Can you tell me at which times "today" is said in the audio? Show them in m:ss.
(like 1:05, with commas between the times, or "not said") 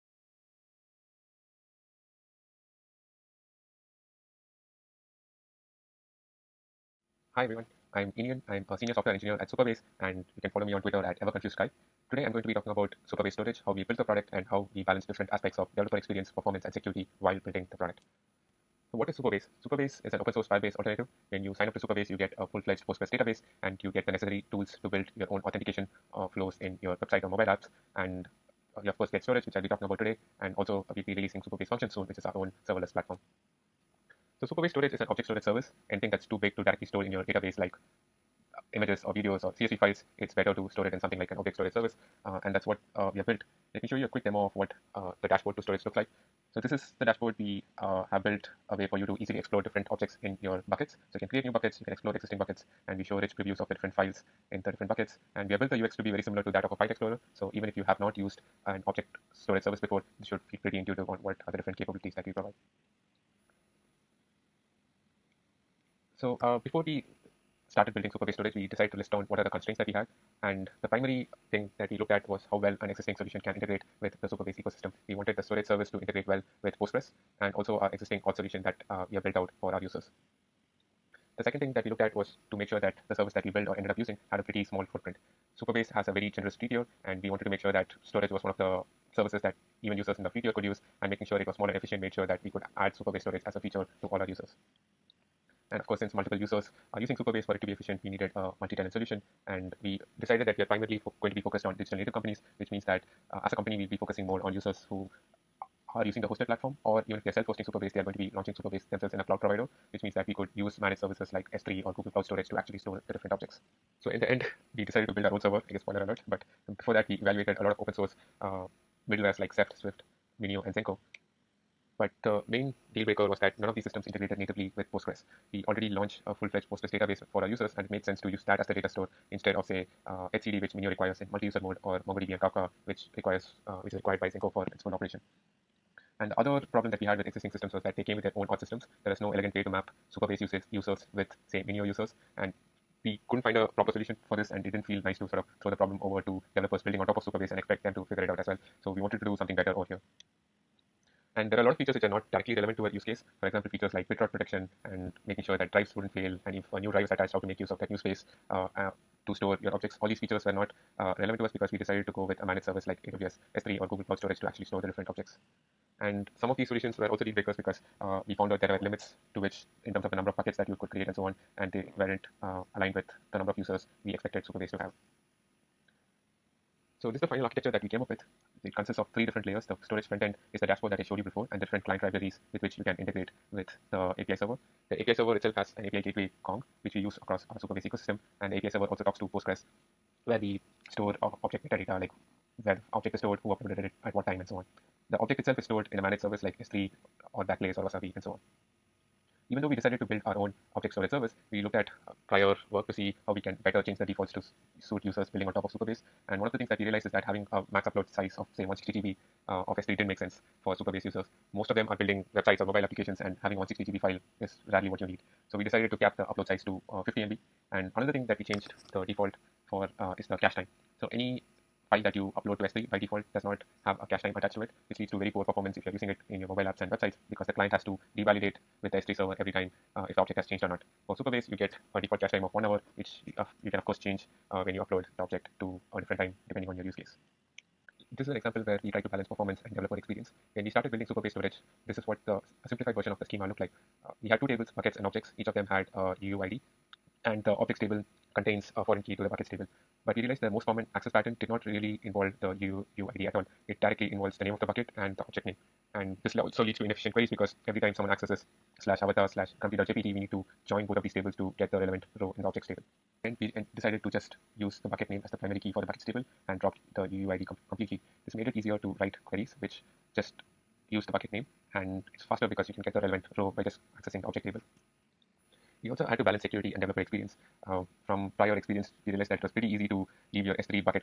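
0:12, 0:29.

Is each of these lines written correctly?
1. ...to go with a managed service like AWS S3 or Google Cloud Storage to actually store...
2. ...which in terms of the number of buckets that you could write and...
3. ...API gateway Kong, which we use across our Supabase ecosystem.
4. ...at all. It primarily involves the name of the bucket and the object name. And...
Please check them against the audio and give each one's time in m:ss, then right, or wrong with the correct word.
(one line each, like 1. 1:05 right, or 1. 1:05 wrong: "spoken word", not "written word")
1. 2:42 right
2. 2:49 wrong: "create", not "write"
3. 3:05 right
4. 4:12 wrong: "directly", not "primarily".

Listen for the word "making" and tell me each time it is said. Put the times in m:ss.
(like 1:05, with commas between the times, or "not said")
1:31, 2:35.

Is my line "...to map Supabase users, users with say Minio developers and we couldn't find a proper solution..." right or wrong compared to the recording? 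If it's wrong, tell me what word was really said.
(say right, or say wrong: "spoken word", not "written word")
wrong: "users", not "developers".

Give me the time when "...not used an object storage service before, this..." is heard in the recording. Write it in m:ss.
0:57.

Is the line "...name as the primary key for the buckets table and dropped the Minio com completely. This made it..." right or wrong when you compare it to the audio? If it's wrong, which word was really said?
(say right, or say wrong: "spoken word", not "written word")
wrong: "UUID", not "Minio".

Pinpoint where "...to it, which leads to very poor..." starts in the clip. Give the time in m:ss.
3:44.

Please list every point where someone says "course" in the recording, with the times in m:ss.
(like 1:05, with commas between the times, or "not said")
0:28, 1:35, 3:53.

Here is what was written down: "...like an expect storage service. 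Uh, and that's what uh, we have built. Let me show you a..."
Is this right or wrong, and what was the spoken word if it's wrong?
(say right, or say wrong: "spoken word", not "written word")
wrong: "object", not "expect".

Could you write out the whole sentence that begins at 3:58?
This is an example where we tried to balance performance and developer experience.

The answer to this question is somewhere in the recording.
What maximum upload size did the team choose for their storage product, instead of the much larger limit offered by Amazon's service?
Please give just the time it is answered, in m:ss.
3:37.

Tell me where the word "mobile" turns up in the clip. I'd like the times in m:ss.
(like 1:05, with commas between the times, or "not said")
0:27, 3:32, 3:46.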